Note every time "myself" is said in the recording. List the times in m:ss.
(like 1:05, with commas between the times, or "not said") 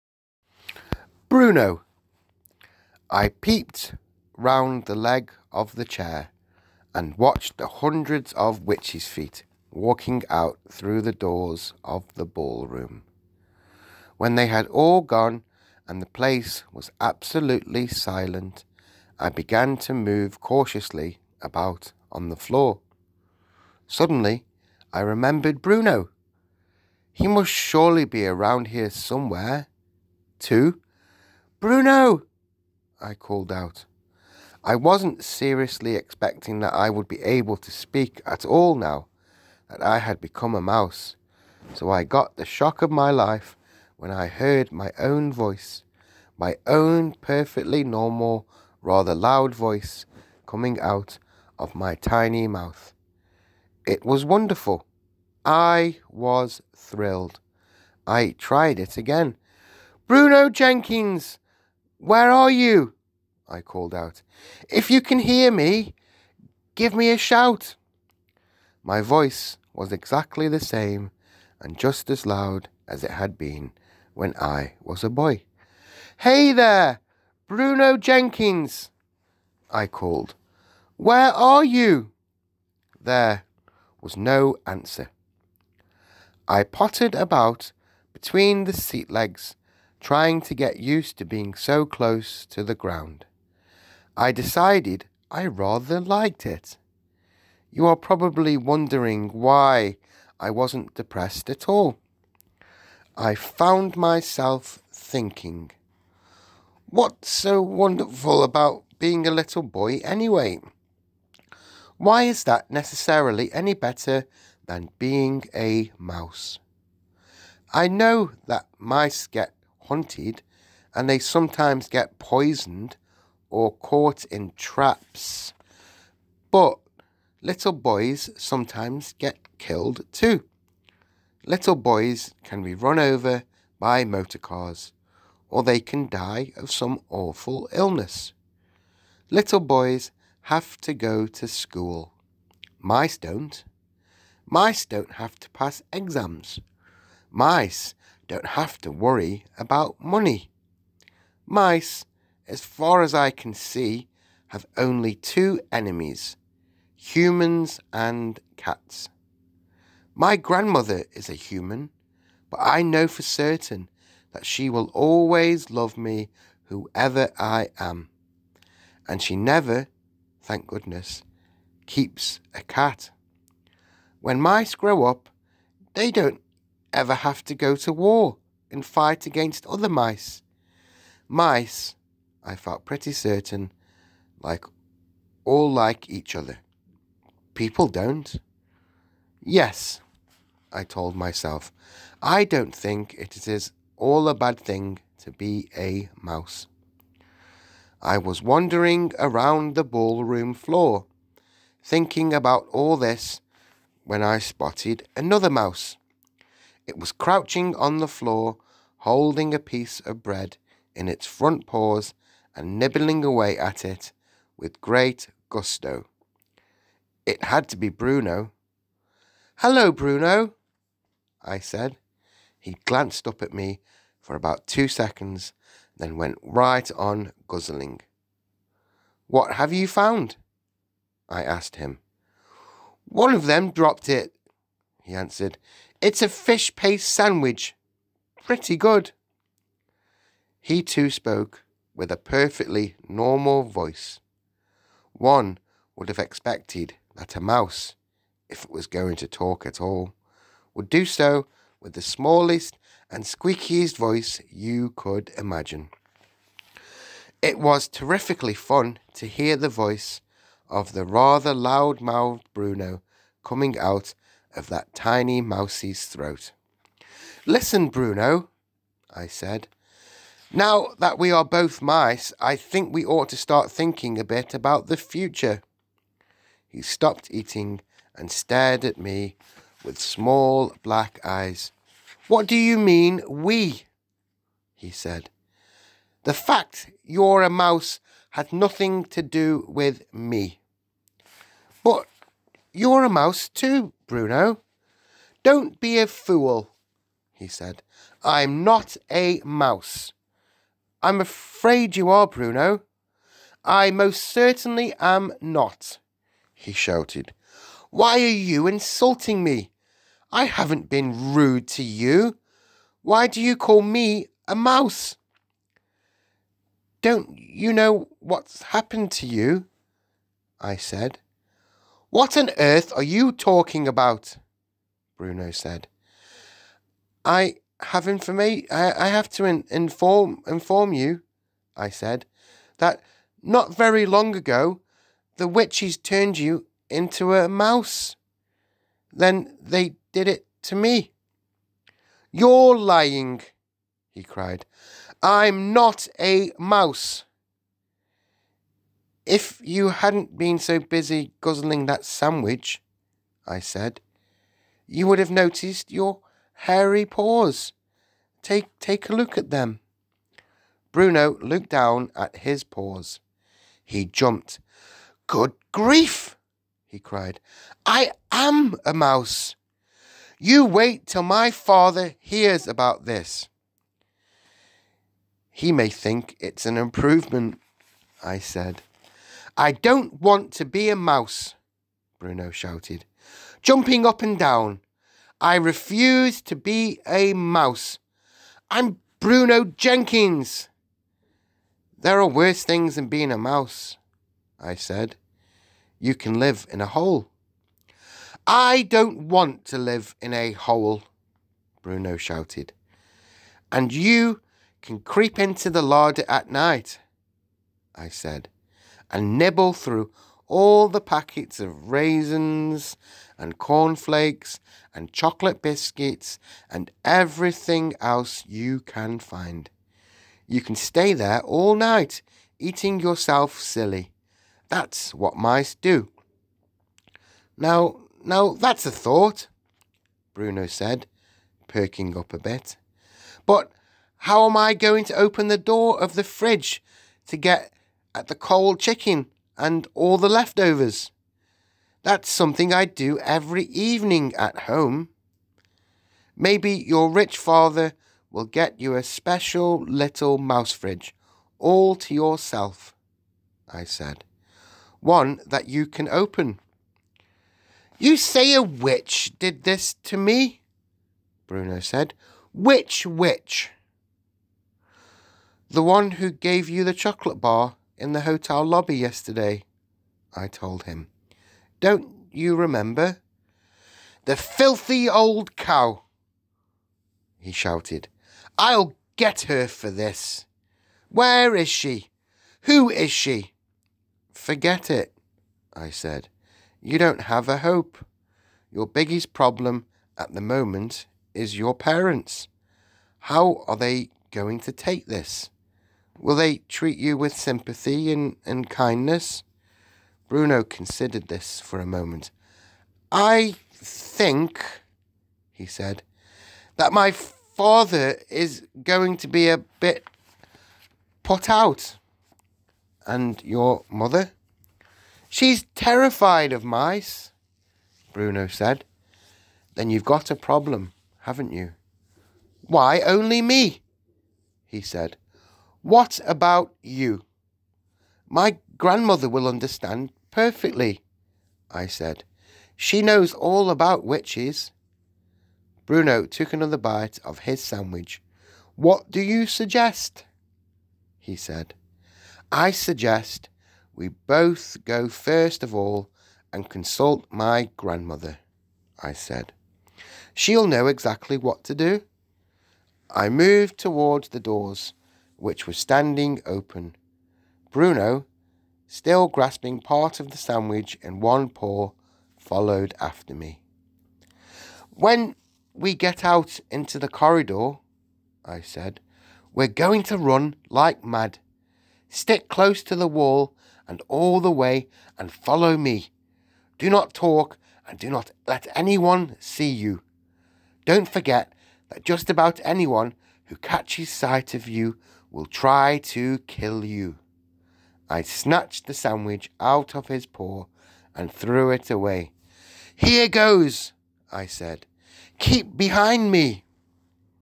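1:43, 3:11.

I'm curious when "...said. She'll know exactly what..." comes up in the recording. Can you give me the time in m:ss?
9:09.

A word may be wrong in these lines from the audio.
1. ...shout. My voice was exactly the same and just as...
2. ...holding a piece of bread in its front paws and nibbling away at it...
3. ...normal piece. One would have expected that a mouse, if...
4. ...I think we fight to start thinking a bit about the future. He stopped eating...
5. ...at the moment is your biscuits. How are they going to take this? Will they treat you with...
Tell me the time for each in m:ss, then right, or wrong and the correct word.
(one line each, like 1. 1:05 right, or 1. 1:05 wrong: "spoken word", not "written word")
1. 1:07 right
2. 3:28 right
3. 4:03 wrong: "voice", not "piece"
4. 4:32 wrong: "ought", not "fight"
5. 8:10 wrong: "parents", not "biscuits".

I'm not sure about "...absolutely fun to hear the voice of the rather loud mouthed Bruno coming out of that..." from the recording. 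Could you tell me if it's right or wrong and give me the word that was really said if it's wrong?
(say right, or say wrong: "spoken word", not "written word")
wrong: "terrifically", not "absolutely".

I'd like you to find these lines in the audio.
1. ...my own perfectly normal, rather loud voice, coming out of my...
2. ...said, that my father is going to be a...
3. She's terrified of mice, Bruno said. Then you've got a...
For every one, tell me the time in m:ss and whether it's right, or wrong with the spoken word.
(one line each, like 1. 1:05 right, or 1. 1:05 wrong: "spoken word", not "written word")
1. 0:46 right
2. 8:25 right
3. 8:35 right.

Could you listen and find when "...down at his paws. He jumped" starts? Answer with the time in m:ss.
6:01.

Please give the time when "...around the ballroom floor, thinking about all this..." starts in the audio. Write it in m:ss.
3:19.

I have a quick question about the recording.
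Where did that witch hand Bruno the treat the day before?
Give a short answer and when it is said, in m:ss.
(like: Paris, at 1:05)
the hotel lobby, at 7:48.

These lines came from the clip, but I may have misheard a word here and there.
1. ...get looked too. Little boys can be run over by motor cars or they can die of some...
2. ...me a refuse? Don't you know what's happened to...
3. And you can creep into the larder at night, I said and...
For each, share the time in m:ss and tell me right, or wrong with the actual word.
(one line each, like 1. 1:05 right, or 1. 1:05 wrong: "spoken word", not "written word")
1. 2:09 wrong: "killed", not "looked"
2. 5:13 wrong: "mouse", not "refuse"
3. 6:43 right.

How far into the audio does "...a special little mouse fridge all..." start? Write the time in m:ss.
7:28.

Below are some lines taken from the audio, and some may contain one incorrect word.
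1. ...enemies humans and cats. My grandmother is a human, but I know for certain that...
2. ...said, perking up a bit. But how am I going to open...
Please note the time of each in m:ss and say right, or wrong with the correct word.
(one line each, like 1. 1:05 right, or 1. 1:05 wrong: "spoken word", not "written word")
1. 2:35 right
2. 7:10 right.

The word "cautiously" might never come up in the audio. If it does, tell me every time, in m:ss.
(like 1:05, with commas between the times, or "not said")
0:20.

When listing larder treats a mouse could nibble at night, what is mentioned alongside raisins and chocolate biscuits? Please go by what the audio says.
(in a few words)
cornflakes.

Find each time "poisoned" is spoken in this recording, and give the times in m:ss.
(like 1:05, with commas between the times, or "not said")
2:02.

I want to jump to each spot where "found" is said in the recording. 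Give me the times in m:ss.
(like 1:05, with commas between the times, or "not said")
1:43, 3:49.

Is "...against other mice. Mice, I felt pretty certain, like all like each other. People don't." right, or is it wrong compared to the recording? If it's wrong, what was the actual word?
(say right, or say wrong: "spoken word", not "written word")
right.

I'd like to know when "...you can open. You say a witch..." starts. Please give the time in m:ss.
7:35.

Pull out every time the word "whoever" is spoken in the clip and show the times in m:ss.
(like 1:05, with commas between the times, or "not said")
2:46.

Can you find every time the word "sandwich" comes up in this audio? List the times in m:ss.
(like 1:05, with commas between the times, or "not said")
3:57, 5:52, 8:57, 9:20, 9:48.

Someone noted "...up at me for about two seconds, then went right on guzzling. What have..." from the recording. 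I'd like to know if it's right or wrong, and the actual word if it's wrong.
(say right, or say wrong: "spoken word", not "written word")
right.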